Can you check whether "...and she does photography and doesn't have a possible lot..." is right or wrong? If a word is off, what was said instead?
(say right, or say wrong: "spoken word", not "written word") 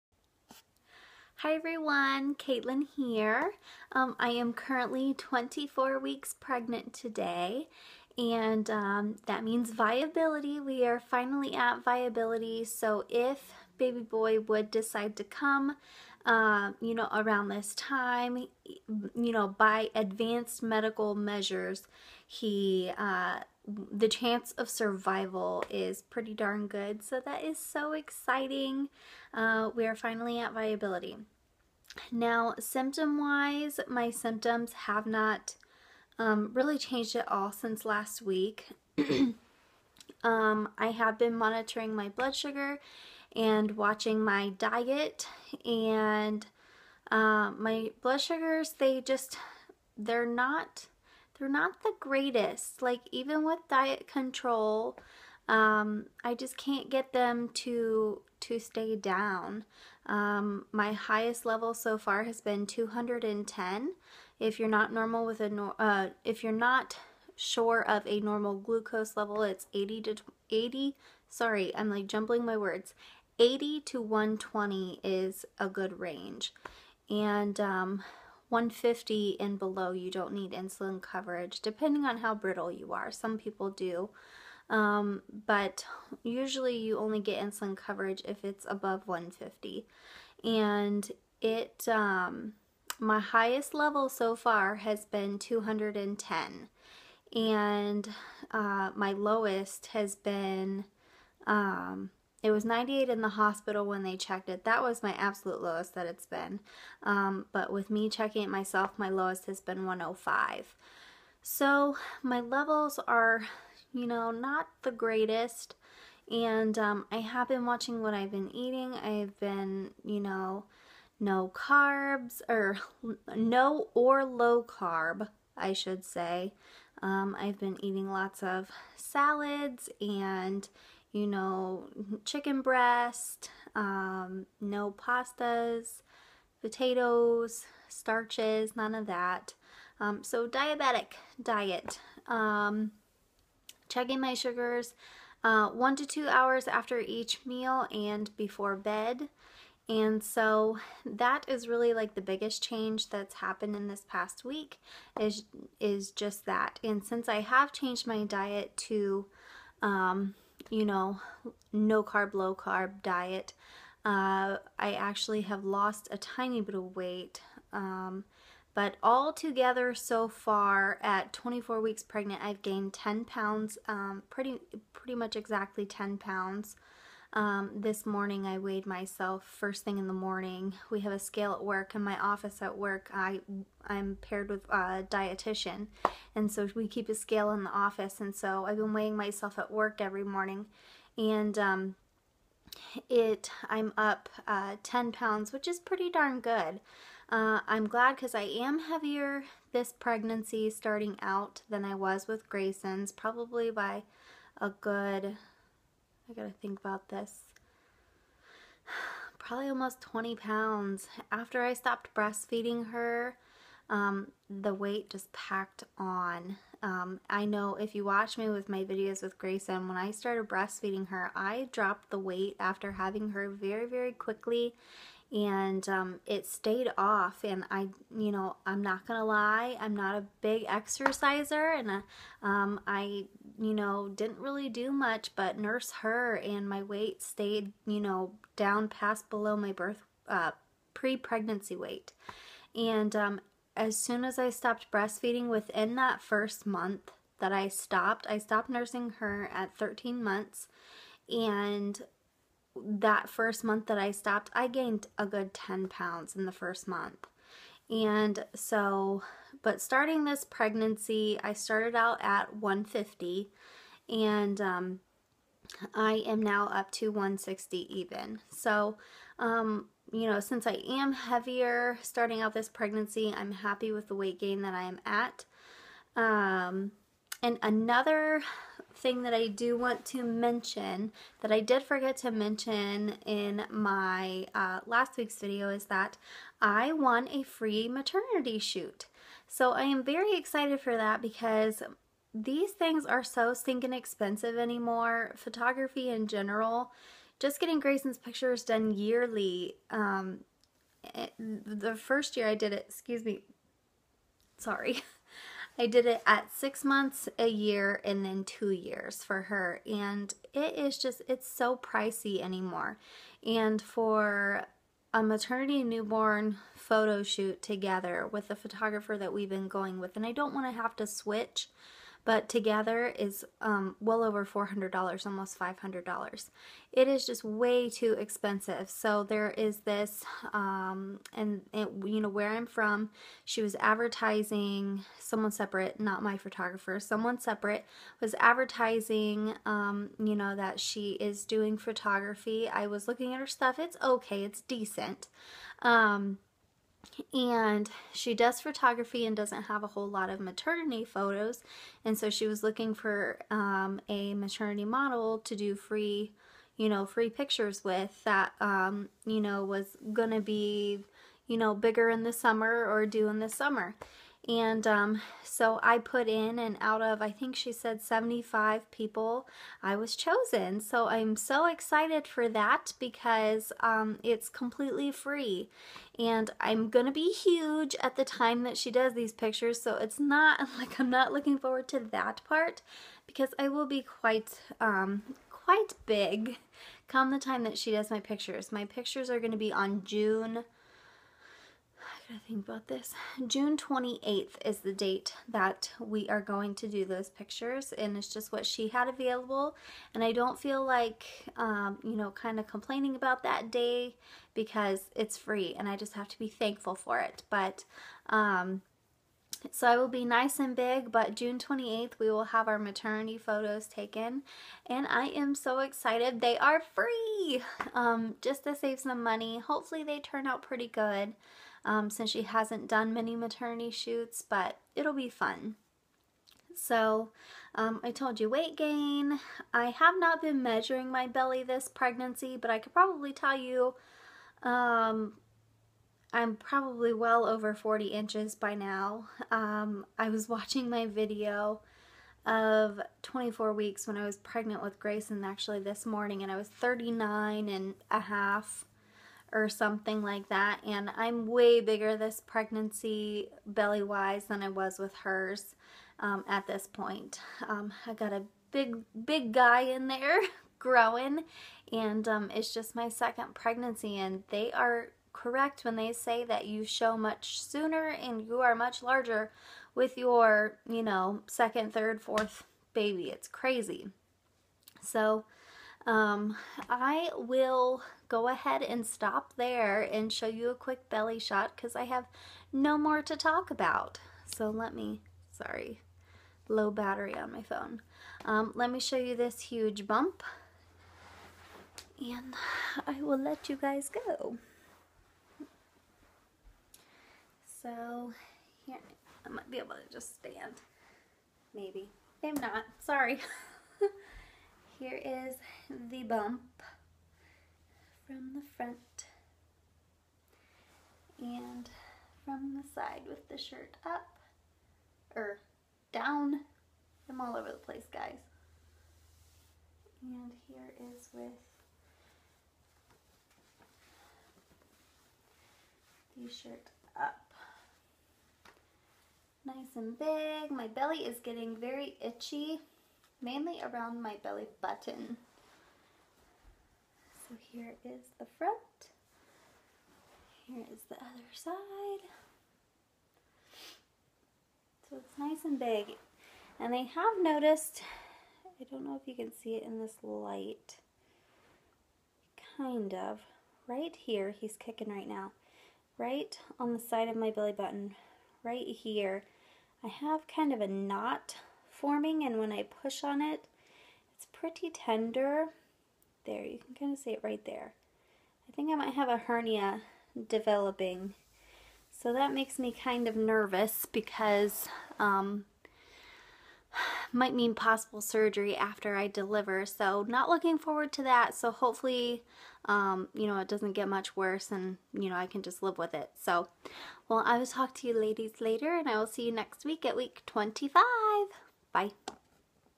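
wrong: "whole", not "possible".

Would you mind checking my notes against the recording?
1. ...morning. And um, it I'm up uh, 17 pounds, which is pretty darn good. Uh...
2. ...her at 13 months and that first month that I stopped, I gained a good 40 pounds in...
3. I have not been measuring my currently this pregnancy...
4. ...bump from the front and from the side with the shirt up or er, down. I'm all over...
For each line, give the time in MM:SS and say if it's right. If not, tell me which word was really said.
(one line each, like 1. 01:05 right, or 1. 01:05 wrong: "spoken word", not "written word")
1. 03:10 wrong: "10", not "17"
2. 04:09 wrong: "10", not "40"
3. 07:09 wrong: "belly", not "currently"
4. 08:26 right.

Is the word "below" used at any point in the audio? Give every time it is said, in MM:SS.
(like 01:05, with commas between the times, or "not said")
01:19, 03:59.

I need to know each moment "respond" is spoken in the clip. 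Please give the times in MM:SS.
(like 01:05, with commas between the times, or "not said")
not said.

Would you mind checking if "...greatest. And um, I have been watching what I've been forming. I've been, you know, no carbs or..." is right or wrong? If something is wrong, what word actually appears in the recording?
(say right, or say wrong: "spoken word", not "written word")
wrong: "eating", not "forming".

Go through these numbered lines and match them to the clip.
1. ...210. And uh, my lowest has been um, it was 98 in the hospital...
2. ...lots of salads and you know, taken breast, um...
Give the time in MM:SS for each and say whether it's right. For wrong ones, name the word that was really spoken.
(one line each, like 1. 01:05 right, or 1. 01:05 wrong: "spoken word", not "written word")
1. 01:35 right
2. 02:08 wrong: "chicken", not "taken".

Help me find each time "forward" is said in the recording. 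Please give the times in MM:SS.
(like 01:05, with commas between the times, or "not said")
06:21, 09:40.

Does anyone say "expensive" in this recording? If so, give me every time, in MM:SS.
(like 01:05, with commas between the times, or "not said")
04:53, 05:28.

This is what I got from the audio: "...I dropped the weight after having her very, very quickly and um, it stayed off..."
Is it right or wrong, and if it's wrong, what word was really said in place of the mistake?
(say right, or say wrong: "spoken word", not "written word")
right.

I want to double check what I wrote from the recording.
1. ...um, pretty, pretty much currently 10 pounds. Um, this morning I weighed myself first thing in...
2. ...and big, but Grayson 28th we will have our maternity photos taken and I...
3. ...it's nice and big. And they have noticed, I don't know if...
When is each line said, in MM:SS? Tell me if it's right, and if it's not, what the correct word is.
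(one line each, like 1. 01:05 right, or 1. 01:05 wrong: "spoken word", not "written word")
1. 02:53 wrong: "exactly", not "currently"
2. 06:50 wrong: "June", not "Grayson"
3. 09:05 right.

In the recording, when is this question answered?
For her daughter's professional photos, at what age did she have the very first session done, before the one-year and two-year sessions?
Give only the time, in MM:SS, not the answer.
05:06.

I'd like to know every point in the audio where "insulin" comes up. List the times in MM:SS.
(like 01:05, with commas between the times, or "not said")
01:20, 01:27.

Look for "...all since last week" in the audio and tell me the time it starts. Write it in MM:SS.
00:37.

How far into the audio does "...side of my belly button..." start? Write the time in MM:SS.
09:16.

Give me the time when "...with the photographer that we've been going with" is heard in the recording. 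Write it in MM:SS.
05:18.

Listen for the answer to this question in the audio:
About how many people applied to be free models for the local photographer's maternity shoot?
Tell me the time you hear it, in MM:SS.
06:08.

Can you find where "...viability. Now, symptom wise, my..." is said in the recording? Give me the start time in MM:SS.
00:30.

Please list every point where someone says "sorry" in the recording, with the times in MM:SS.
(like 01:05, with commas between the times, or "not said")
01:11, 05:04, 08:05, 08:22.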